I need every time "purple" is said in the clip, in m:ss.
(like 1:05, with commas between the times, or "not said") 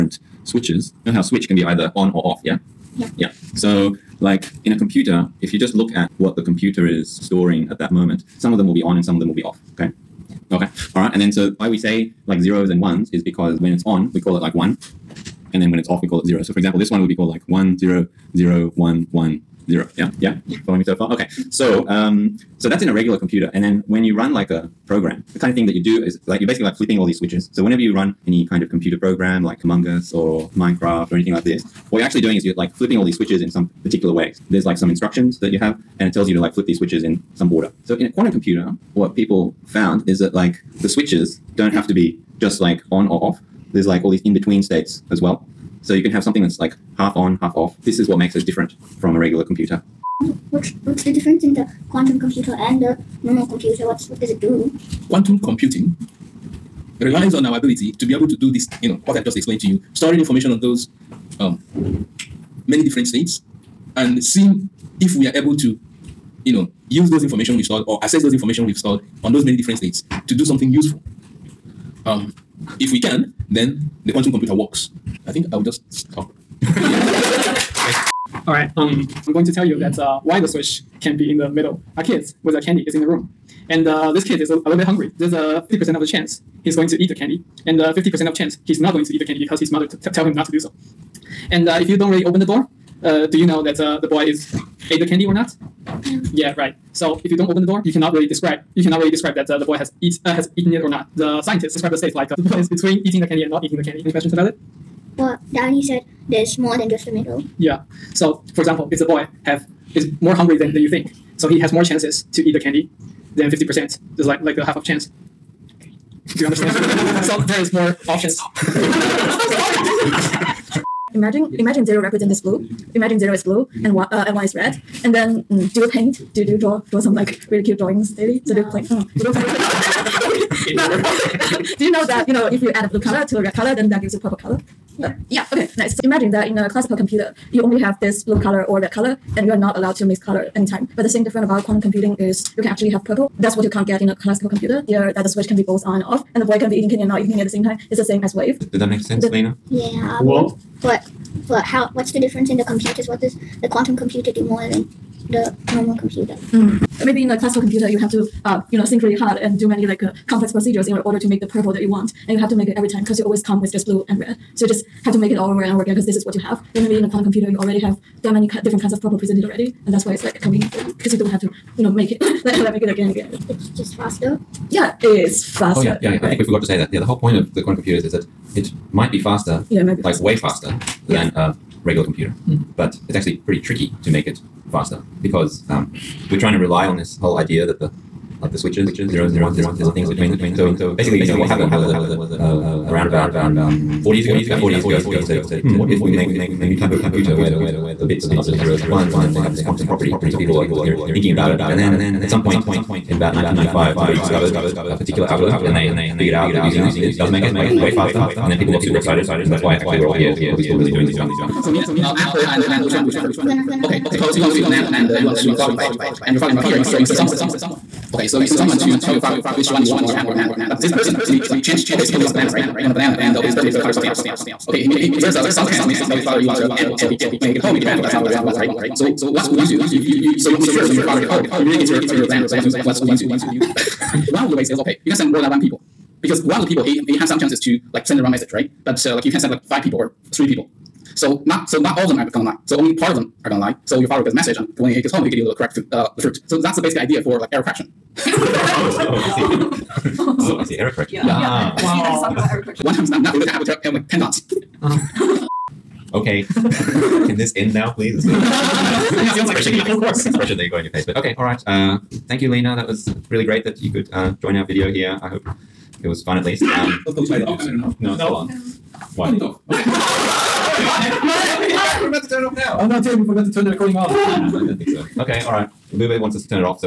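2:14, 2:23, 2:41, 2:49.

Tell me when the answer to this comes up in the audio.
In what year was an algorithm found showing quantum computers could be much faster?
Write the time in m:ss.
3:23.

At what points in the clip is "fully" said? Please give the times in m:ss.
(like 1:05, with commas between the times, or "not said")
not said.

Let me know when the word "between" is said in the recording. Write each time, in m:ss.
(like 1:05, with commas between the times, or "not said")
0:44, 1:42, 3:10.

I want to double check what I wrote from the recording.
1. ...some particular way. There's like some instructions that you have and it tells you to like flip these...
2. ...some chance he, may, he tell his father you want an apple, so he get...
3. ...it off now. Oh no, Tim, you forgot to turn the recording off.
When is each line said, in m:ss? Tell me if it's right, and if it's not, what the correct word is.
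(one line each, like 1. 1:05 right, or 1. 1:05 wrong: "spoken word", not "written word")
1. 0:33 right
2. 3:45 right
3. 4:32 right.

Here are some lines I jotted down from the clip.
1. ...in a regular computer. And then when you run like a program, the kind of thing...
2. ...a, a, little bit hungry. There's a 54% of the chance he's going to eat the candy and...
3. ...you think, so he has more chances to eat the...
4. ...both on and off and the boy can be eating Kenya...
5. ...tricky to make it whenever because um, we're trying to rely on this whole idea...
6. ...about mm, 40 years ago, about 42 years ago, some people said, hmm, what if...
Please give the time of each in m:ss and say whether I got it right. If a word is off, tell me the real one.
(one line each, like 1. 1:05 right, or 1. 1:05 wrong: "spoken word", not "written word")
1. 0:22 right
2. 1:24 wrong: "50", not "54"
3. 1:50 right
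4. 2:25 right
5. 3:03 wrong: "faster", not "whenever"
6. 3:13 wrong: "40", not "42".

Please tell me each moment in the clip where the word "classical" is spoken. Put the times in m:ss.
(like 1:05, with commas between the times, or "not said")
2:16, 2:24, 2:37.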